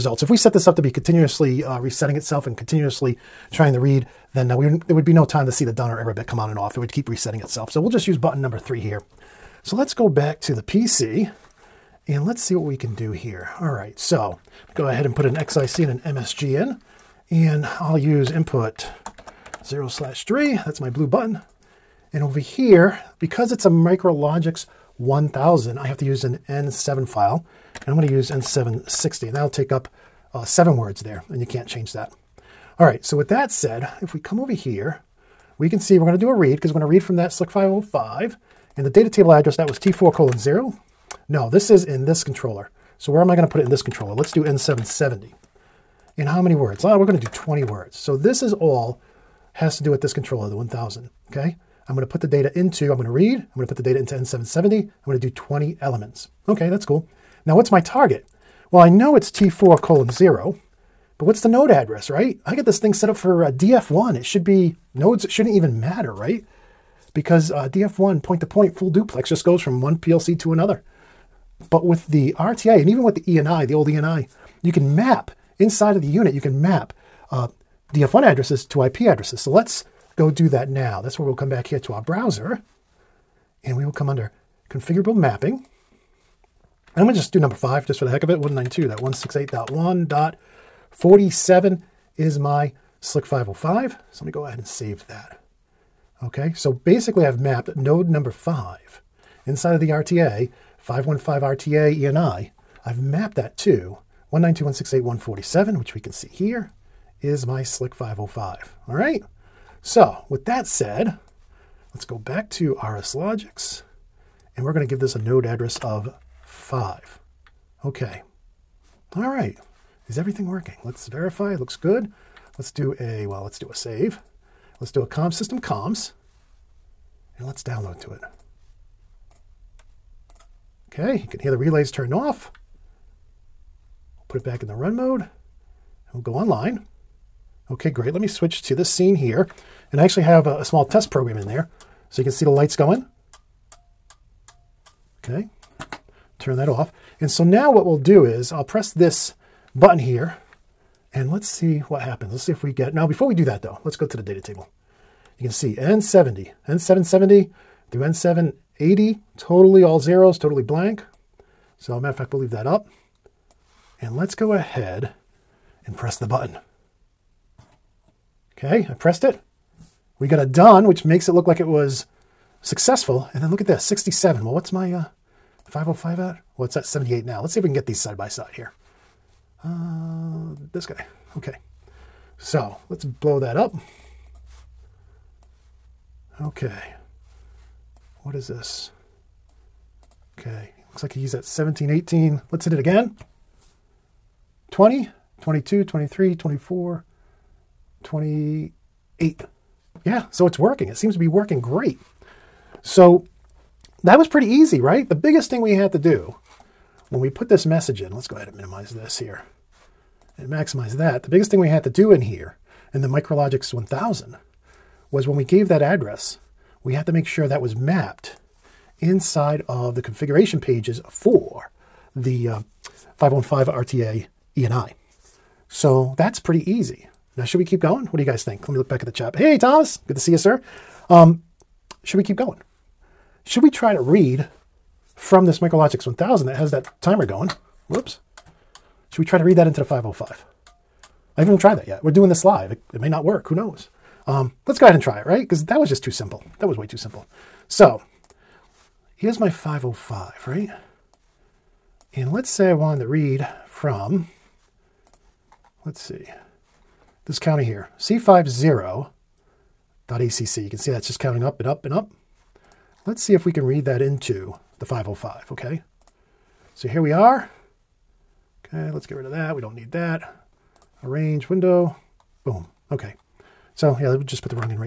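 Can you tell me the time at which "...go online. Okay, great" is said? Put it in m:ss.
2:16.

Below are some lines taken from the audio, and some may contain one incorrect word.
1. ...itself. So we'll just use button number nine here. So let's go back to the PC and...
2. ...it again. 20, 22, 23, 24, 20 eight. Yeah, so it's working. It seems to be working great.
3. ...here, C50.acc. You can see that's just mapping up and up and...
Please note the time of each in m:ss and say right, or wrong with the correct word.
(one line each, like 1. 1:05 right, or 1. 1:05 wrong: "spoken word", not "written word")
1. 0:07 wrong: "three", not "nine"
2. 3:12 right
3. 4:17 wrong: "counting", not "mapping".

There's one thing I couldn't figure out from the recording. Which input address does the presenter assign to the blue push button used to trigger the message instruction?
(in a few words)
input 0/3.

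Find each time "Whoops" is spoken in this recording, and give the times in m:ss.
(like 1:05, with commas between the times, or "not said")
3:57.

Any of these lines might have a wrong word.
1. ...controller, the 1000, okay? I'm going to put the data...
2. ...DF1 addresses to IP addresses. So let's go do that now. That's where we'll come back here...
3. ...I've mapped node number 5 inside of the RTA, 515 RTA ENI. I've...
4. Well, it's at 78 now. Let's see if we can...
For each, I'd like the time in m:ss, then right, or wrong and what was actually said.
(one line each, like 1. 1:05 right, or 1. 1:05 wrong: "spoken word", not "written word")
1. 0:50 right
2. 1:17 right
3. 1:37 right
4. 2:56 right.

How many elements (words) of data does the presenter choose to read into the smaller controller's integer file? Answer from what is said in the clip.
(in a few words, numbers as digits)
20.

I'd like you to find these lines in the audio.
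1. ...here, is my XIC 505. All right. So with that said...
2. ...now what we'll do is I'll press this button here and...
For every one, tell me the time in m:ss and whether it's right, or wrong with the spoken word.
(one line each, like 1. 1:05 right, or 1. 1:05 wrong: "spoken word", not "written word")
1. 1:46 wrong: "Slick", not "XIC"
2. 2:27 right.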